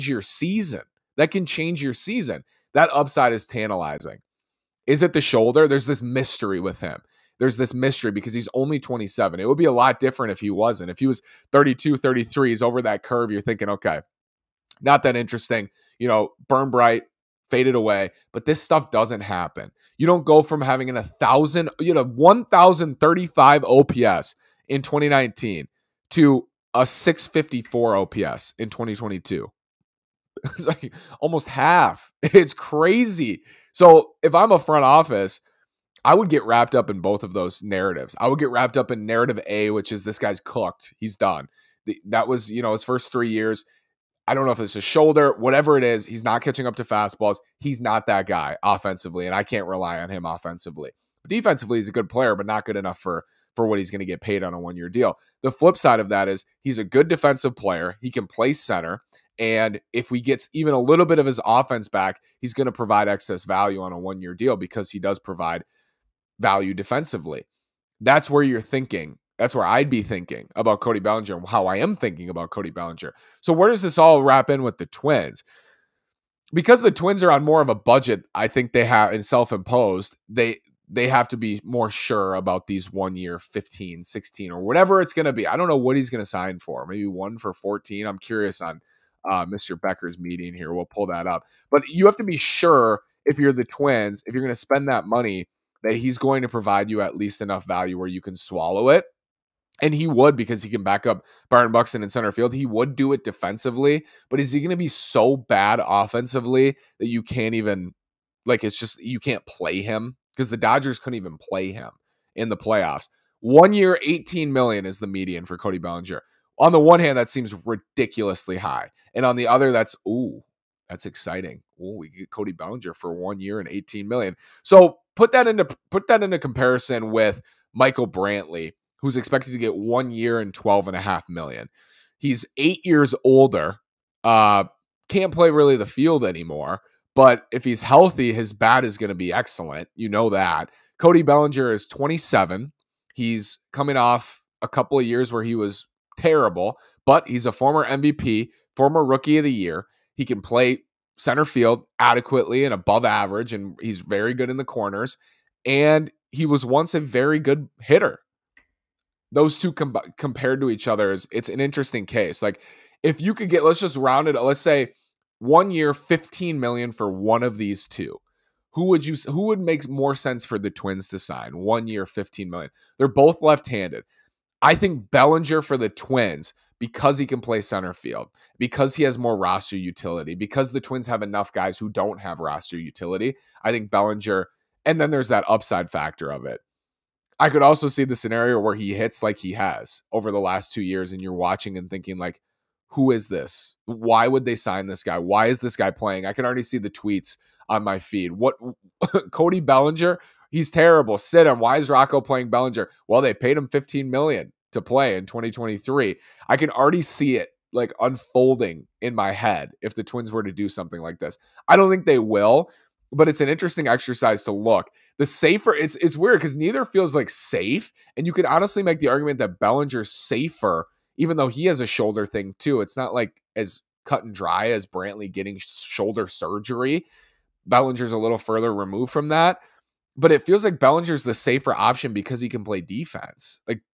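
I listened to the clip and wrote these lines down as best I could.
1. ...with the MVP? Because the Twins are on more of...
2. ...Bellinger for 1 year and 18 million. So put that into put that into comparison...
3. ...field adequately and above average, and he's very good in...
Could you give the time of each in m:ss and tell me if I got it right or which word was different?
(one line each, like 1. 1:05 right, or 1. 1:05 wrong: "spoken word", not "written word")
1. 1:14 wrong: "Twins", not "MVP"
2. 2:02 right
3. 2:31 right.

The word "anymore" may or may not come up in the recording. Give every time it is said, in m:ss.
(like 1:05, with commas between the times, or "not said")
2:16.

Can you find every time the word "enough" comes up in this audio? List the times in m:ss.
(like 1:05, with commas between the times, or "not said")
0:52, 1:37, 3:01.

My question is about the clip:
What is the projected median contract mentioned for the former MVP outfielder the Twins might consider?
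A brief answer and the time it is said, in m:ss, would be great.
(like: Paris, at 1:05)
1 year, $18 million, at 1:53.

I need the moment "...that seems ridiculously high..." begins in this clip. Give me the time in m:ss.
1:57.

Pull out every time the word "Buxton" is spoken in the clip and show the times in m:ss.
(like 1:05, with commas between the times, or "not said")
1:41.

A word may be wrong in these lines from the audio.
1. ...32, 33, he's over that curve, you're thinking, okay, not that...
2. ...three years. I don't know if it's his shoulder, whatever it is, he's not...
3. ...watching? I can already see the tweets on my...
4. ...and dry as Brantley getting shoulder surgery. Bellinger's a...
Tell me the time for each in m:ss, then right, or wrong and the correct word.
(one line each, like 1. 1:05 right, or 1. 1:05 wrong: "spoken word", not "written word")
1. 0:11 right
2. 0:43 right
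3. 3:15 wrong: "playing", not "watching"
4. 3:44 right.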